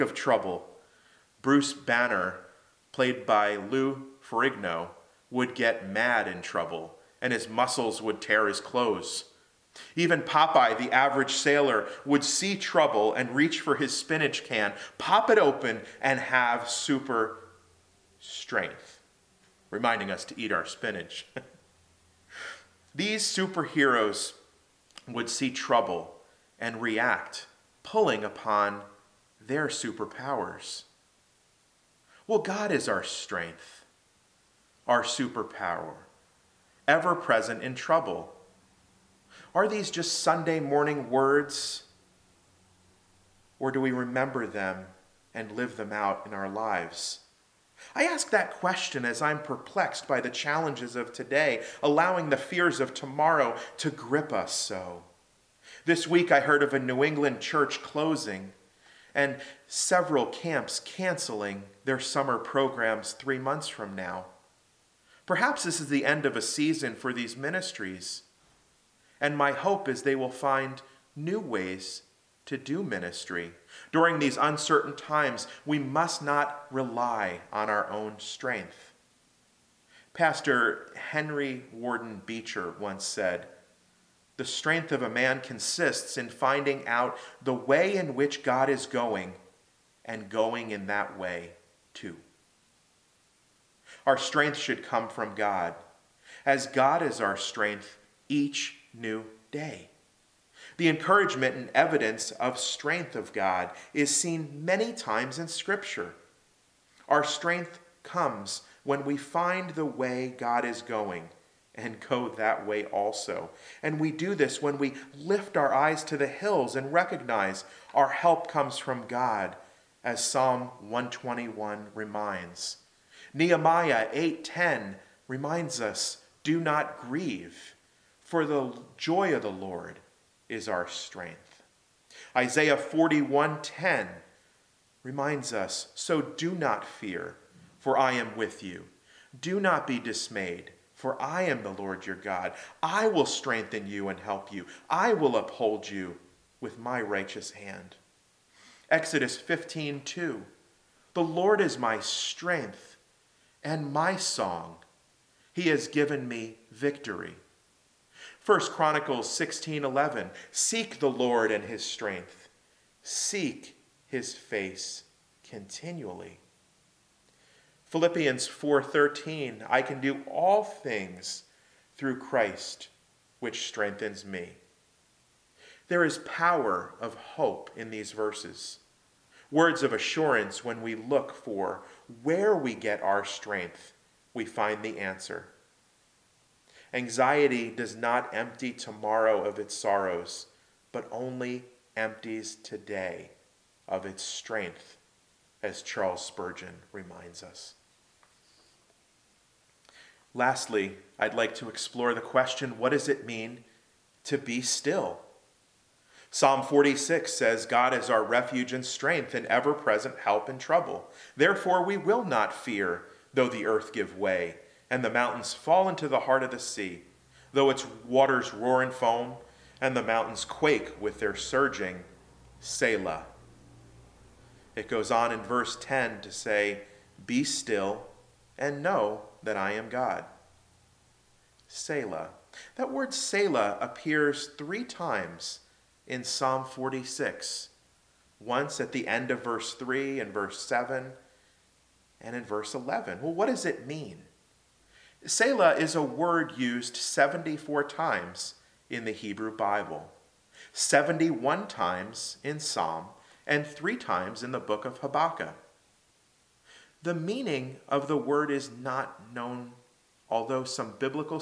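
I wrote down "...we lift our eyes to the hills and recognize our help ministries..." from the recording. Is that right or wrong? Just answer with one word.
wrong.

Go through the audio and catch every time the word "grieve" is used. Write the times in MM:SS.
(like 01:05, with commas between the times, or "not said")
02:06.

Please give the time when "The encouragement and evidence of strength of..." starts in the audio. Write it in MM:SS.
01:40.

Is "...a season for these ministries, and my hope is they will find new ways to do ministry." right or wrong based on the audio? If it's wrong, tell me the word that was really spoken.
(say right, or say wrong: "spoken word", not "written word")
right.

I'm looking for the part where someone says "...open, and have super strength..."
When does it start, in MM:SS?
00:15.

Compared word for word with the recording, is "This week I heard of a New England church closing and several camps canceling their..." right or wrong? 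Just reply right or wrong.
right.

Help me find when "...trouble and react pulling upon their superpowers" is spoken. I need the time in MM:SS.
00:25.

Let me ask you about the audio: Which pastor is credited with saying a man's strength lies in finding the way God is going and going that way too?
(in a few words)
Henry Warden Beecher.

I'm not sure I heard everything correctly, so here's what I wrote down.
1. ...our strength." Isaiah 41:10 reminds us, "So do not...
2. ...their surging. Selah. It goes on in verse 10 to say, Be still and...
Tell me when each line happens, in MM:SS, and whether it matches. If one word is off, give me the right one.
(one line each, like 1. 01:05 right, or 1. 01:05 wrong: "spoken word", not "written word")
1. 02:10 right
2. 03:41 right.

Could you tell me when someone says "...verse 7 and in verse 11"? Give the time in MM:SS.
04:00.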